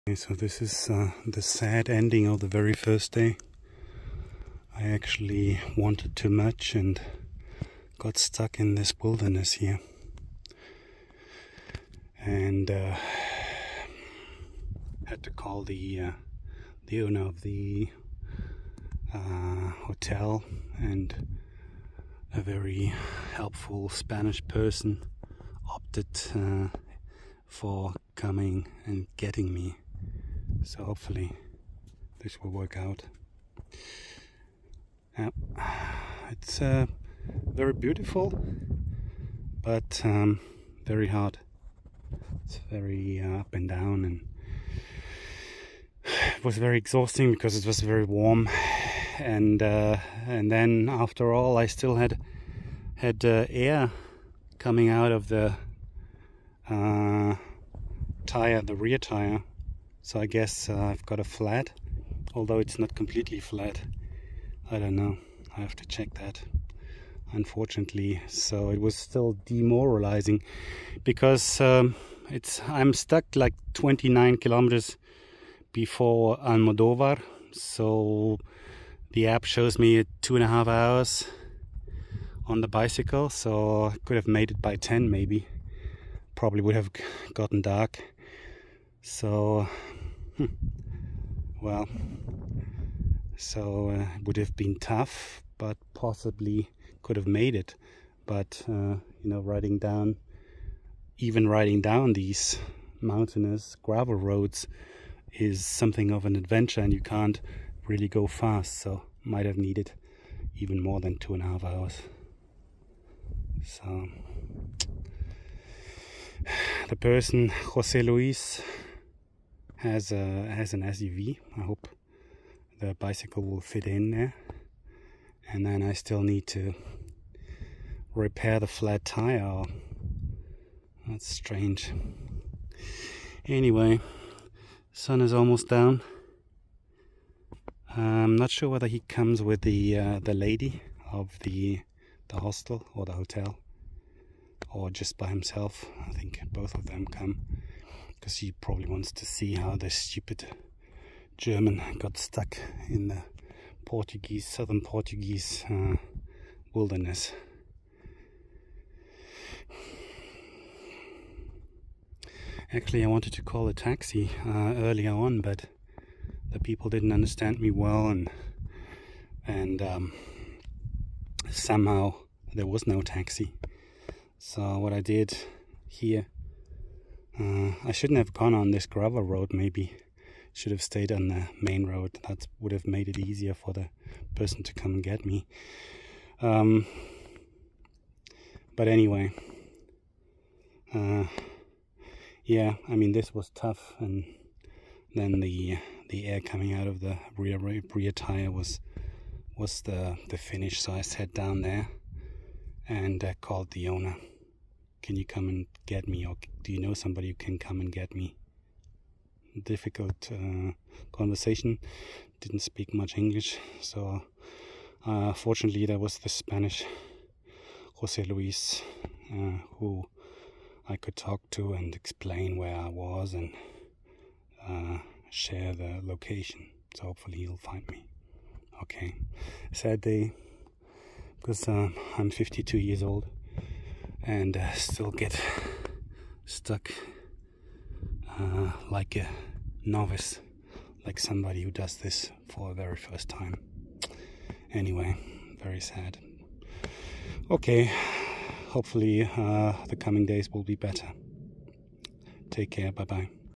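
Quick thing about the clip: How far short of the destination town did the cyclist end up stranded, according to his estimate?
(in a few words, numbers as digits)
29 kilometers.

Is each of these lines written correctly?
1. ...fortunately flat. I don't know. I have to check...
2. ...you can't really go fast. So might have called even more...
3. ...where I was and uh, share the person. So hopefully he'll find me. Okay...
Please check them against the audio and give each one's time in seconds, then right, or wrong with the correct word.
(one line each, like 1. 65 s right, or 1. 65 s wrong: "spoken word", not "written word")
1. 62 s wrong: "completely", not "fortunately"
2. 106 s wrong: "needed", not "called"
3. 222 s wrong: "location", not "person".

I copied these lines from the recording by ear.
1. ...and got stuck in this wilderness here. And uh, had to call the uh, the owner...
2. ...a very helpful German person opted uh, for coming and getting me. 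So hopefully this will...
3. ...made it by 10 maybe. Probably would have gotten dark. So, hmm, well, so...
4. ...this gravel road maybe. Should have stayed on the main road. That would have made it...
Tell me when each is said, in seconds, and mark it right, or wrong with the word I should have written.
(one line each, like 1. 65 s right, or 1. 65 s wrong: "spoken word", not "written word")
1. 6 s right
2. 22 s wrong: "Spanish", not "German"
3. 84 s right
4. 178 s right.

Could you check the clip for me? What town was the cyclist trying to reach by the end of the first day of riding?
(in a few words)
Almodovar.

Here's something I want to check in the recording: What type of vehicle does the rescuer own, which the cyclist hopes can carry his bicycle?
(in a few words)
SUV.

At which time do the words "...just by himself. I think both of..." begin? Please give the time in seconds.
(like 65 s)
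144 s.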